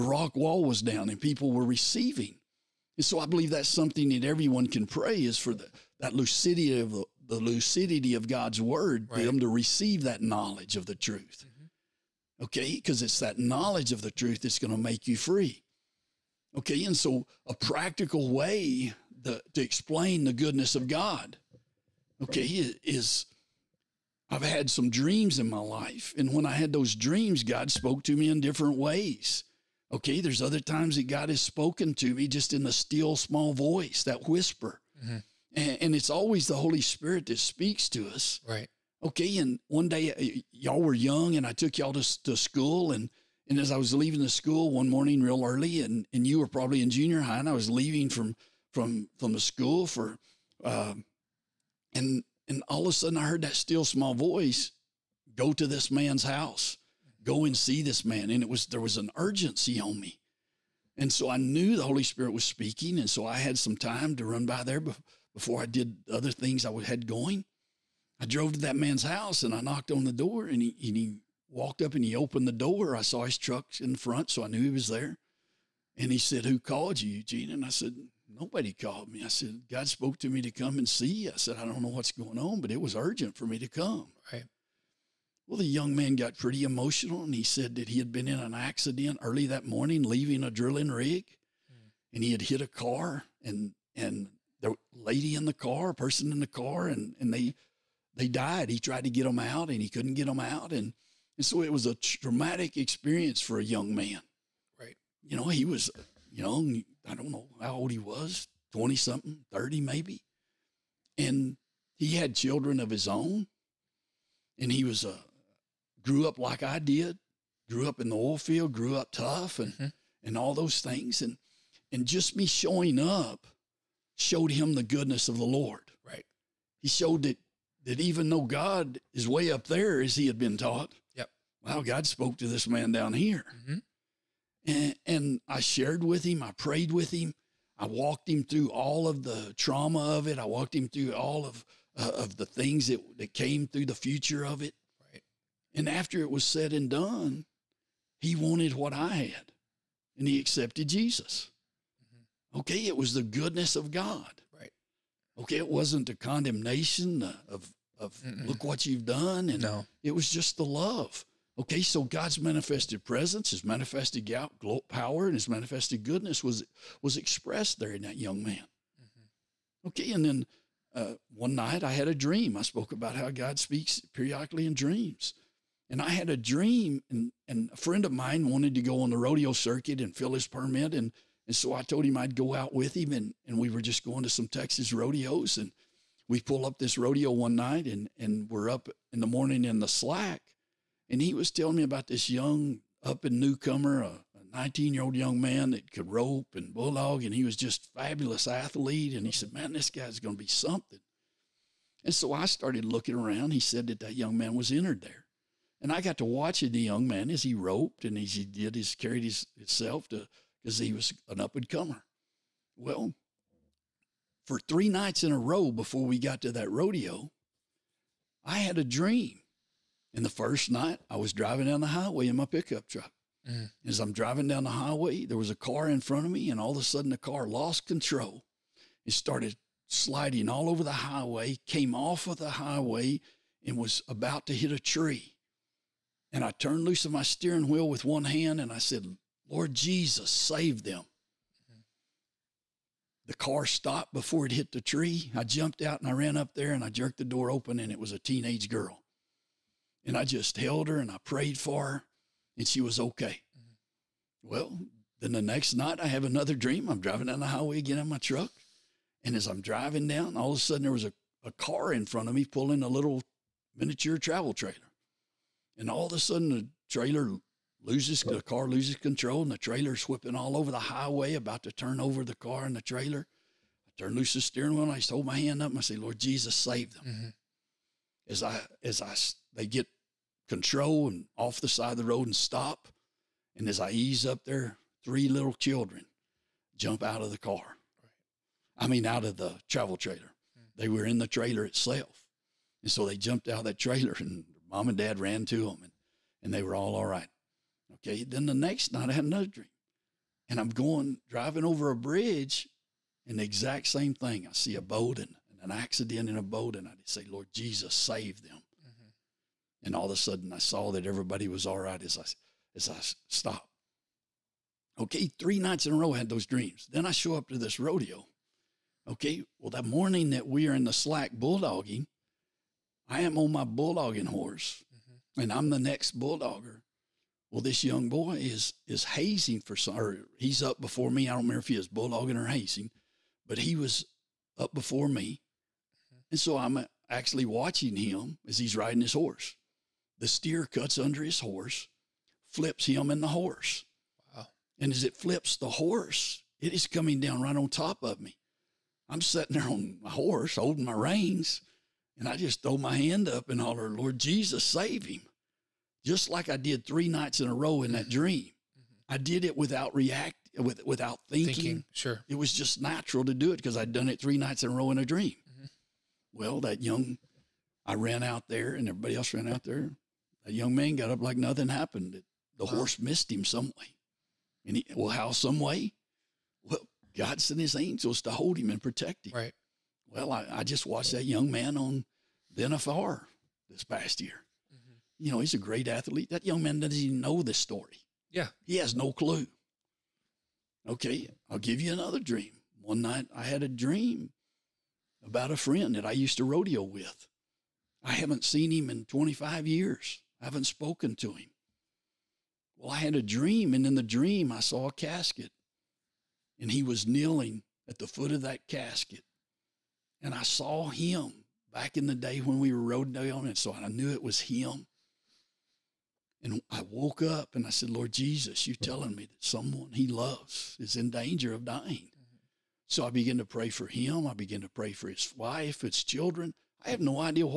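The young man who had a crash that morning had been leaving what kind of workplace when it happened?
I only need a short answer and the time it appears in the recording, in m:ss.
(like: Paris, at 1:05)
A drilling rig, at 1:30.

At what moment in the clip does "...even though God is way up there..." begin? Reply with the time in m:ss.
2:07.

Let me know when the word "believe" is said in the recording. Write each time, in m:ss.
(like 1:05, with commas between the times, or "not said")
0:03.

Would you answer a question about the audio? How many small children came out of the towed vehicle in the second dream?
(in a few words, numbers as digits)
3.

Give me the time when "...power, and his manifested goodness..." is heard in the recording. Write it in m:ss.
2:44.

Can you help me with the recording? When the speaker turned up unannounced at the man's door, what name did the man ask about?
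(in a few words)
Eugene.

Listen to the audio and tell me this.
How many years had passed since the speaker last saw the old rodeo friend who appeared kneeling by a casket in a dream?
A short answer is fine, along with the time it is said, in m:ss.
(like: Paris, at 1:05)
25, at 6:39.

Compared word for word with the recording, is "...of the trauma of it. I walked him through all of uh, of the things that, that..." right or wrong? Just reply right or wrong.
right.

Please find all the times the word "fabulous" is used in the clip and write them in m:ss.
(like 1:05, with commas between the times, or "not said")
3:17.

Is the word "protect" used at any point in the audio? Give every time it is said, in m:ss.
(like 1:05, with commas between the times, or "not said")
6:18.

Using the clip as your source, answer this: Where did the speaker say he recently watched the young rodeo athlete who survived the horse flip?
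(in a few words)
The NFR.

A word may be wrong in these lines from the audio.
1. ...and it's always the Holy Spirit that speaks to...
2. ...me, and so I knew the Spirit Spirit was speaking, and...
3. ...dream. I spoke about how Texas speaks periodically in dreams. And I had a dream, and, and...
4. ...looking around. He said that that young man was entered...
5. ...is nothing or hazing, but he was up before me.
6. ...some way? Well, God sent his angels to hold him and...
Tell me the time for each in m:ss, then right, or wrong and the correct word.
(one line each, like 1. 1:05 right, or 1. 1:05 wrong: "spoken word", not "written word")
1. 0:35 right
2. 0:59 wrong: "Holy", not "Spirit"
3. 2:52 wrong: "God", not "Texas"
4. 3:22 right
5. 5:31 wrong: "bulldogging", not "nothing"
6. 6:15 right.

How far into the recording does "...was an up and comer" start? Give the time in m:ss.
3:30.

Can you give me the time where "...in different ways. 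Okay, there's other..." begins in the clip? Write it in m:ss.
0:28.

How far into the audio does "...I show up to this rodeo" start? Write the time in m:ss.
5:17.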